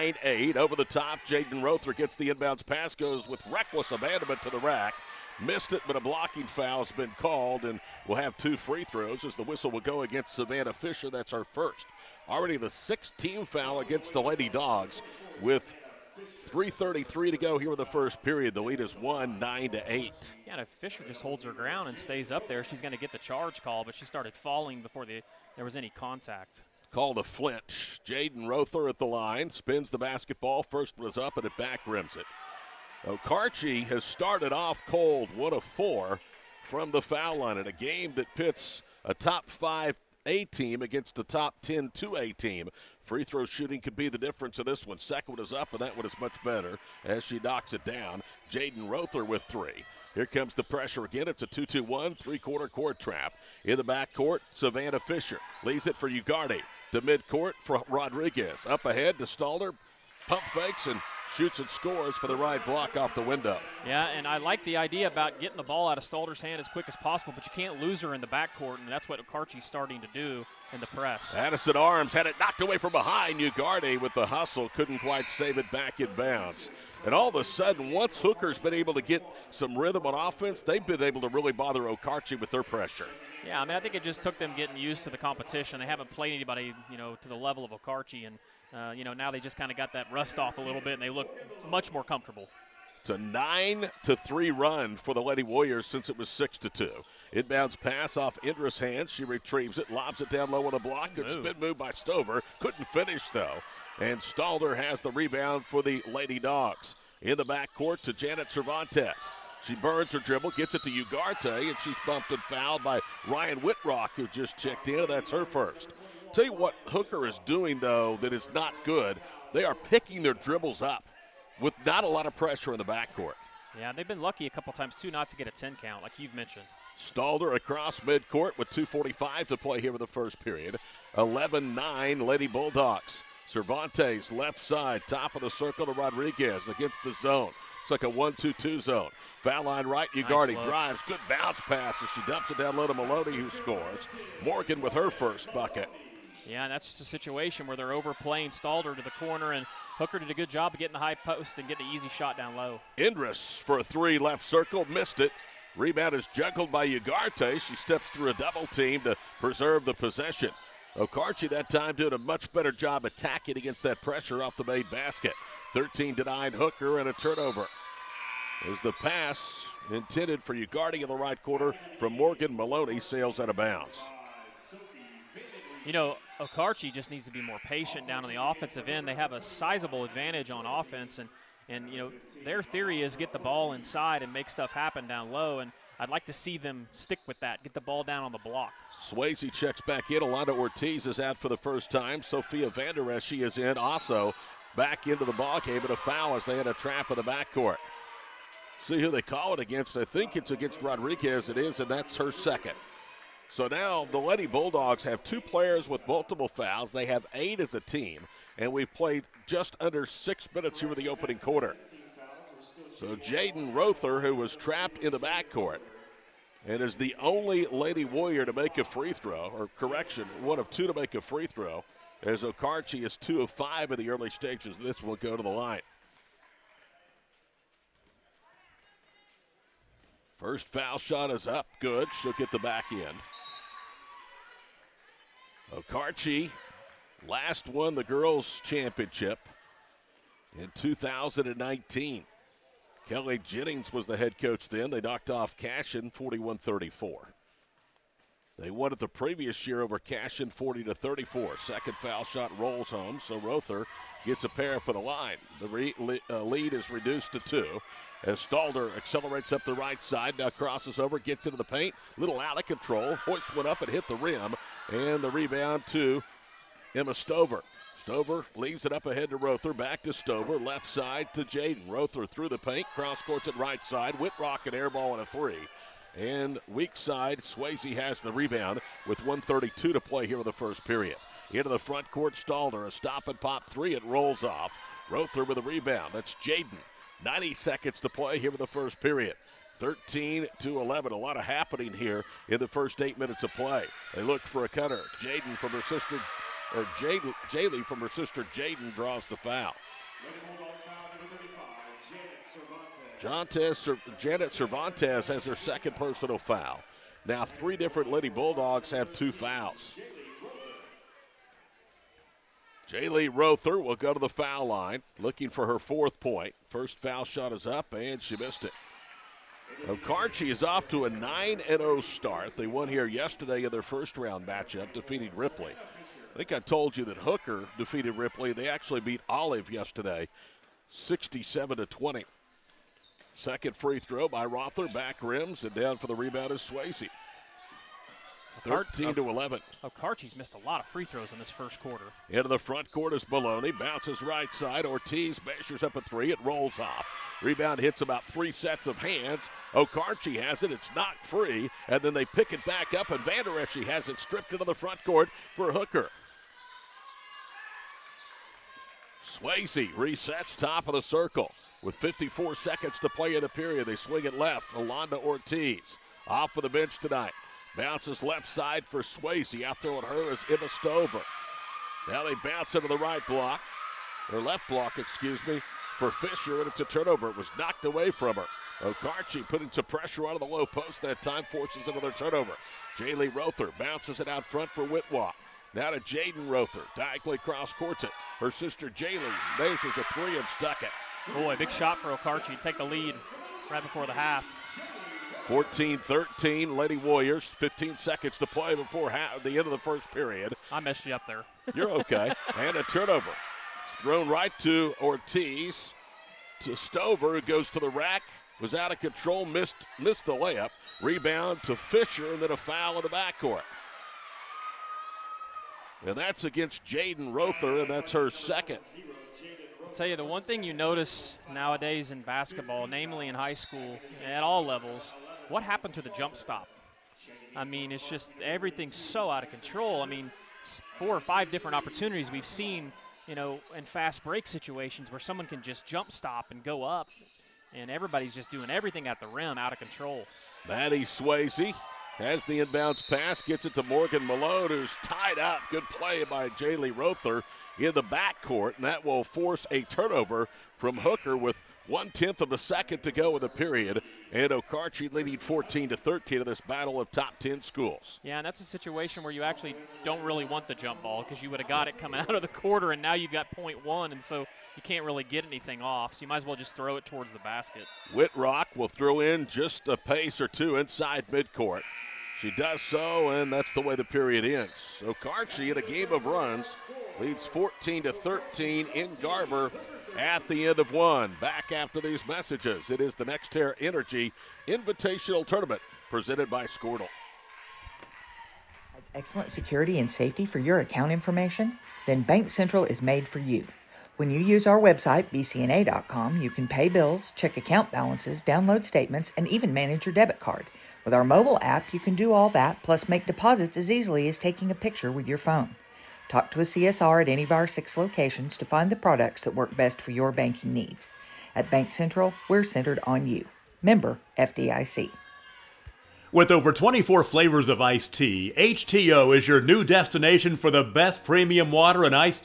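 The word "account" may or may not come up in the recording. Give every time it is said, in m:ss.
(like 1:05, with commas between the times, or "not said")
8:10, 8:17.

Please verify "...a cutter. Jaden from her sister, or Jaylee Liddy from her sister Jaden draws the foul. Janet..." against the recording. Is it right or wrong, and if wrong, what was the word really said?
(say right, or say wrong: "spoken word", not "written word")
wrong: "Jaylee", not "Liddy".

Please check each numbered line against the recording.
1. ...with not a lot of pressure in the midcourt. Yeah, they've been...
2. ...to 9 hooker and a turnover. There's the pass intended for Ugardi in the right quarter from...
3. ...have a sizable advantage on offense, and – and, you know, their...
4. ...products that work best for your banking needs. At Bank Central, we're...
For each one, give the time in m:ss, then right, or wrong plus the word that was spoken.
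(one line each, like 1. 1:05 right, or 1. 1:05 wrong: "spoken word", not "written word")
1. 2:01 wrong: "backcourt", not "midcourt"
2. 2:46 right
3. 2:59 right
4. 8:28 right.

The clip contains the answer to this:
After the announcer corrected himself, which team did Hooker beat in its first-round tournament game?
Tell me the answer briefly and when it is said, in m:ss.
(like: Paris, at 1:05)
Olive, at 5:29.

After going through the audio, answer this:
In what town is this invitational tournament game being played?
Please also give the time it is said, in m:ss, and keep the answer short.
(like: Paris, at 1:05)
Garber, at 7:59.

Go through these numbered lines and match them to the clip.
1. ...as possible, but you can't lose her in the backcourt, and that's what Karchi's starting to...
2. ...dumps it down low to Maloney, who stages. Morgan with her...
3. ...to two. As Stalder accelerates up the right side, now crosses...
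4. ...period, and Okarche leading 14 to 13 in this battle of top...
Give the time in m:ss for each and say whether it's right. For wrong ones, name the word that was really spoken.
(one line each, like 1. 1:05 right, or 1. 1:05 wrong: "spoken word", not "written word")
1. 1:06 right
2. 2:22 wrong: "scores", not "stages"
3. 4:17 right
4. 7:33 right.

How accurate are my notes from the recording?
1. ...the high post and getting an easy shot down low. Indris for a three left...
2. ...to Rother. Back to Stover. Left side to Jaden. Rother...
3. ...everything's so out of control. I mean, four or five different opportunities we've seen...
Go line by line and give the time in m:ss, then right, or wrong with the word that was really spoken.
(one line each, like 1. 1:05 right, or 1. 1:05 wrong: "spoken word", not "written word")
1. 2:30 right
2. 4:29 right
3. 7:08 right.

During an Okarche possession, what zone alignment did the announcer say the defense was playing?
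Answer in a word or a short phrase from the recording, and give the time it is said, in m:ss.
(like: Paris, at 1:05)
1-2-2 zone, at 2:18.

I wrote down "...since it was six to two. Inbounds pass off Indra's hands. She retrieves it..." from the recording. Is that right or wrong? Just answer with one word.
right.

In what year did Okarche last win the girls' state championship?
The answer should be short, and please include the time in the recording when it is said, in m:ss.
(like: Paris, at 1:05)
2019, at 4:00.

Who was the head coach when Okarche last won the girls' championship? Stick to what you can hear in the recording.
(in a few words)
Kelly Jennings.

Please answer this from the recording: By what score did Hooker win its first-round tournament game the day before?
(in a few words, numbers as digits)
67 to 20.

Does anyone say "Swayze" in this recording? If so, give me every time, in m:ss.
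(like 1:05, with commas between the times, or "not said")
3:09, 4:37, 5:36, 5:59, 6:09, 7:21.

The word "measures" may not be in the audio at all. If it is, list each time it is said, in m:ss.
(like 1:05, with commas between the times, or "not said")
5:45, 6:29.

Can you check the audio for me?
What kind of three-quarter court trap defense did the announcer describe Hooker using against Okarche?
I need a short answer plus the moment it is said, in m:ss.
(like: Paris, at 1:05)
2-2-1, at 0:51.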